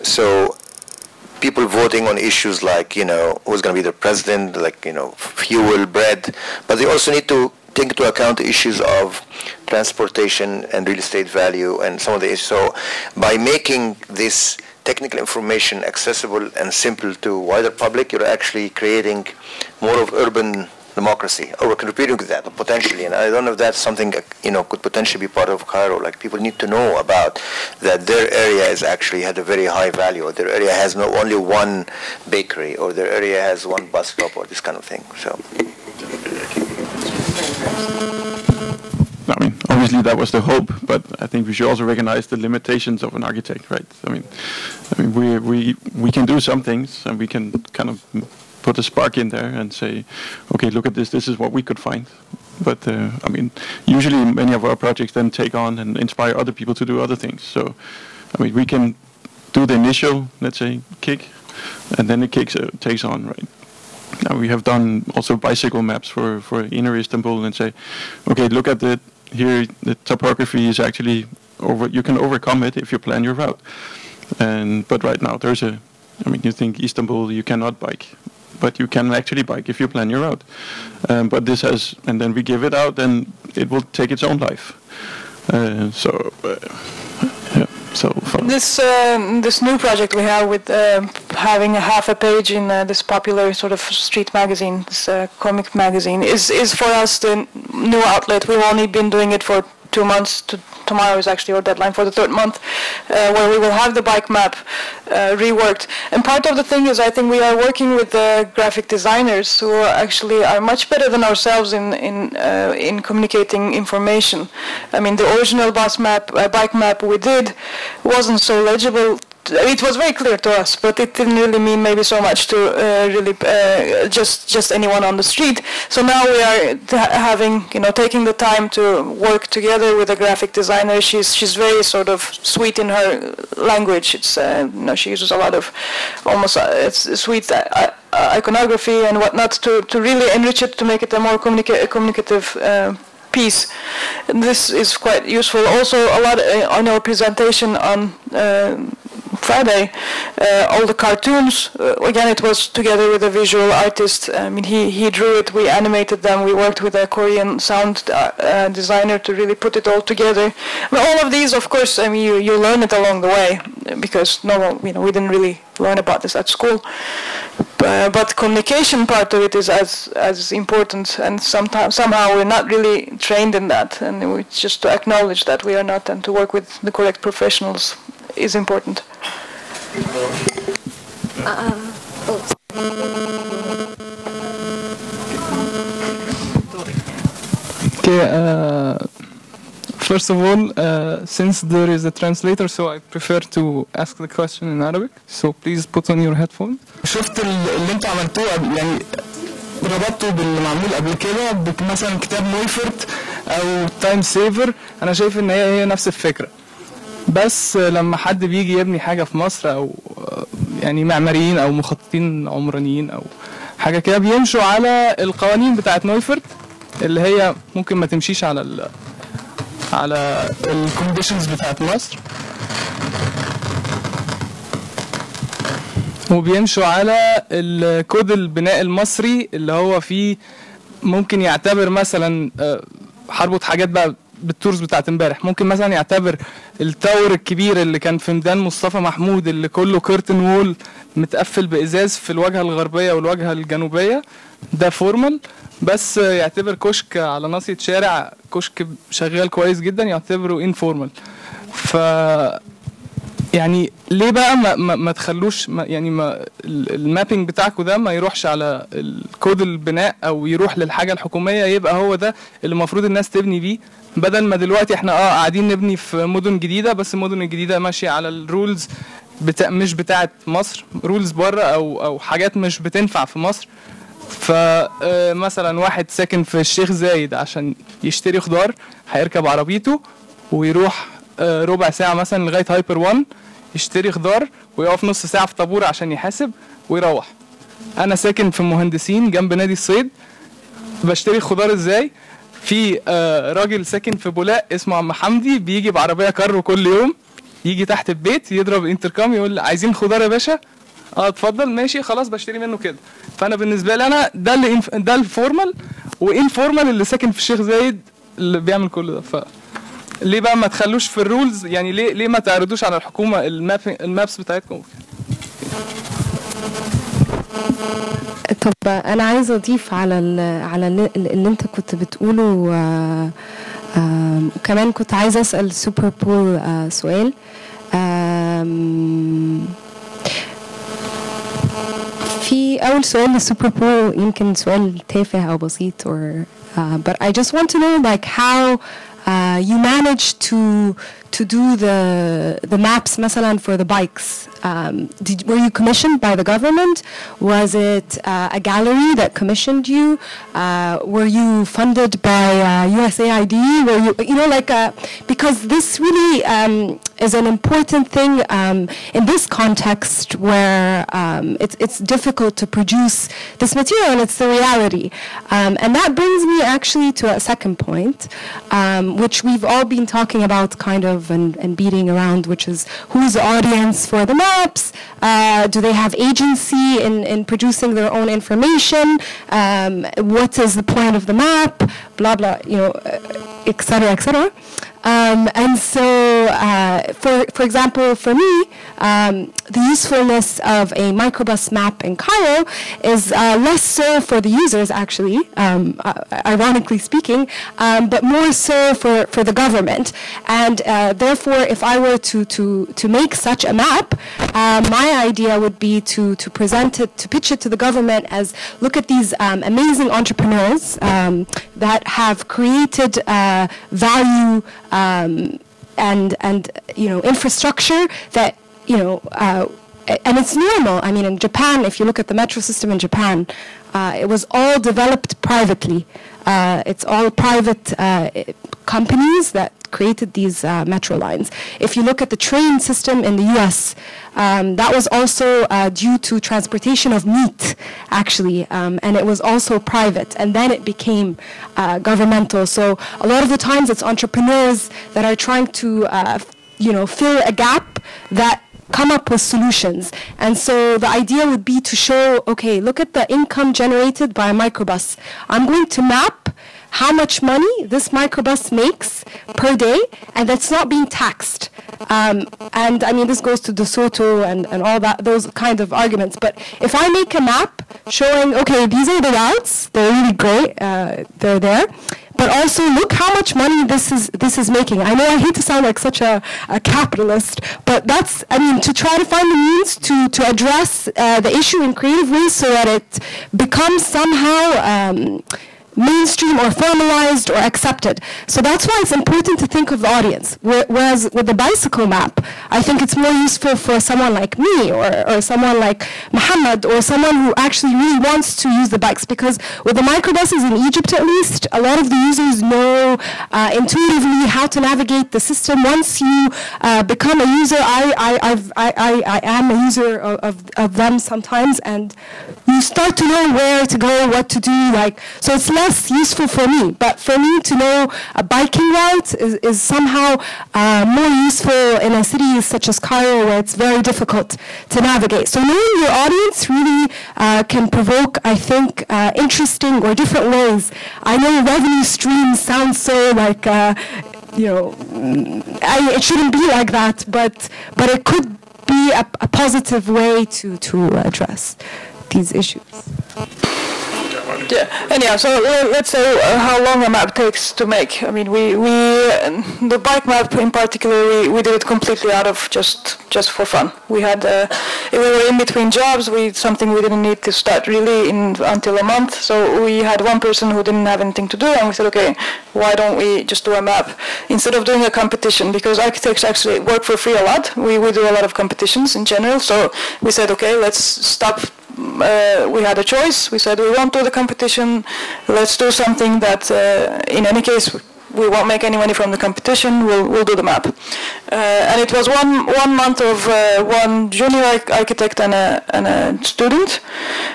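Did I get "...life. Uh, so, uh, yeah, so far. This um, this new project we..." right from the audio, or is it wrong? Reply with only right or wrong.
right.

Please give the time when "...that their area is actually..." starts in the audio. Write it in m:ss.
0:27.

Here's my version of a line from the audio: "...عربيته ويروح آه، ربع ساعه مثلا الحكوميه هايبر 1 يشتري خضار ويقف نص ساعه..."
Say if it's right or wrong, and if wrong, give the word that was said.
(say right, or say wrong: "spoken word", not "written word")
wrong: "لغايه", not "الحكوميه".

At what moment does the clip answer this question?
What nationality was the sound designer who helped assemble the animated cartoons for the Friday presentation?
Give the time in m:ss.
2:37.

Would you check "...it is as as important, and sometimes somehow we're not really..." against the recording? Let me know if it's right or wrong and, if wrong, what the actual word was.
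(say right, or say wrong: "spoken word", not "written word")
right.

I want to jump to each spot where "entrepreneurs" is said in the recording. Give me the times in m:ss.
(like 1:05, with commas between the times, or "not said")
6:50, 7:24.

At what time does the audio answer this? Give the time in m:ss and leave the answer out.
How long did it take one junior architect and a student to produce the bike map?
9:42.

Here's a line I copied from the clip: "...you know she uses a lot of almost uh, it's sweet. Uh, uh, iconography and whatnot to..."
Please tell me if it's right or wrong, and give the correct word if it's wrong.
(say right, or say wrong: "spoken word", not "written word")
right.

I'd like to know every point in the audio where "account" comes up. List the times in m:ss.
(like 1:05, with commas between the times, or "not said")
0:08.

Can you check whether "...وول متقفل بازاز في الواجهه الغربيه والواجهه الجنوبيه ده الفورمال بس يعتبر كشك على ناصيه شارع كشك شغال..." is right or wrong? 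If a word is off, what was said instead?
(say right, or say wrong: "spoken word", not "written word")
wrong: "فورمال", not "الفورمال".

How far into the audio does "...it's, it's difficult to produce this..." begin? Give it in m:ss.
6:01.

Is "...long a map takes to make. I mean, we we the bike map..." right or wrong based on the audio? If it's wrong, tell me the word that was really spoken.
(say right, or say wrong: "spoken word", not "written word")
right.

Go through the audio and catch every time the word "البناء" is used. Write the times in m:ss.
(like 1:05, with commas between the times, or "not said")
3:48, 4:19.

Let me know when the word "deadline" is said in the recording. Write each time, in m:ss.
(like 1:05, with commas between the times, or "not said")
1:41.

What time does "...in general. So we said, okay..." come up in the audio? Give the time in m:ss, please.
9:29.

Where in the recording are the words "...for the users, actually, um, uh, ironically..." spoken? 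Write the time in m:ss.
6:34.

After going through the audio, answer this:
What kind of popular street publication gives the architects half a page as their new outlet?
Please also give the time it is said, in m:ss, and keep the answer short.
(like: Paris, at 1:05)
comic magazine, at 1:35.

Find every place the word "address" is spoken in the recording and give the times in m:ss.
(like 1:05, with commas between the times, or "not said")
8:00, 9:01.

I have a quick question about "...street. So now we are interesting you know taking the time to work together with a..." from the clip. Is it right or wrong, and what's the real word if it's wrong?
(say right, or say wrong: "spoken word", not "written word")
wrong: "having", not "interesting".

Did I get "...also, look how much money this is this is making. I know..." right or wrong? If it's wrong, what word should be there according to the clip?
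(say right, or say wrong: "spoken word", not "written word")
right.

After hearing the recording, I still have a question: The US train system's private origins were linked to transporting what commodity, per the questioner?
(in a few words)
meat.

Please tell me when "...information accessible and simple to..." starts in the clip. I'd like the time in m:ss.
0:15.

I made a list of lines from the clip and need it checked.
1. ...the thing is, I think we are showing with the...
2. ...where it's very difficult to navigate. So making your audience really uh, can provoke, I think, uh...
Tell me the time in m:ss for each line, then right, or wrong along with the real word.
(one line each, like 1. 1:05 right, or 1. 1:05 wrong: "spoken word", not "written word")
1. 1:46 wrong: "working", not "showing"
2. 8:43 wrong: "knowing", not "making".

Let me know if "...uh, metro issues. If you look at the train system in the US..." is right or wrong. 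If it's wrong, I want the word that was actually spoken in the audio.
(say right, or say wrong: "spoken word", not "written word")
wrong: "lines", not "issues".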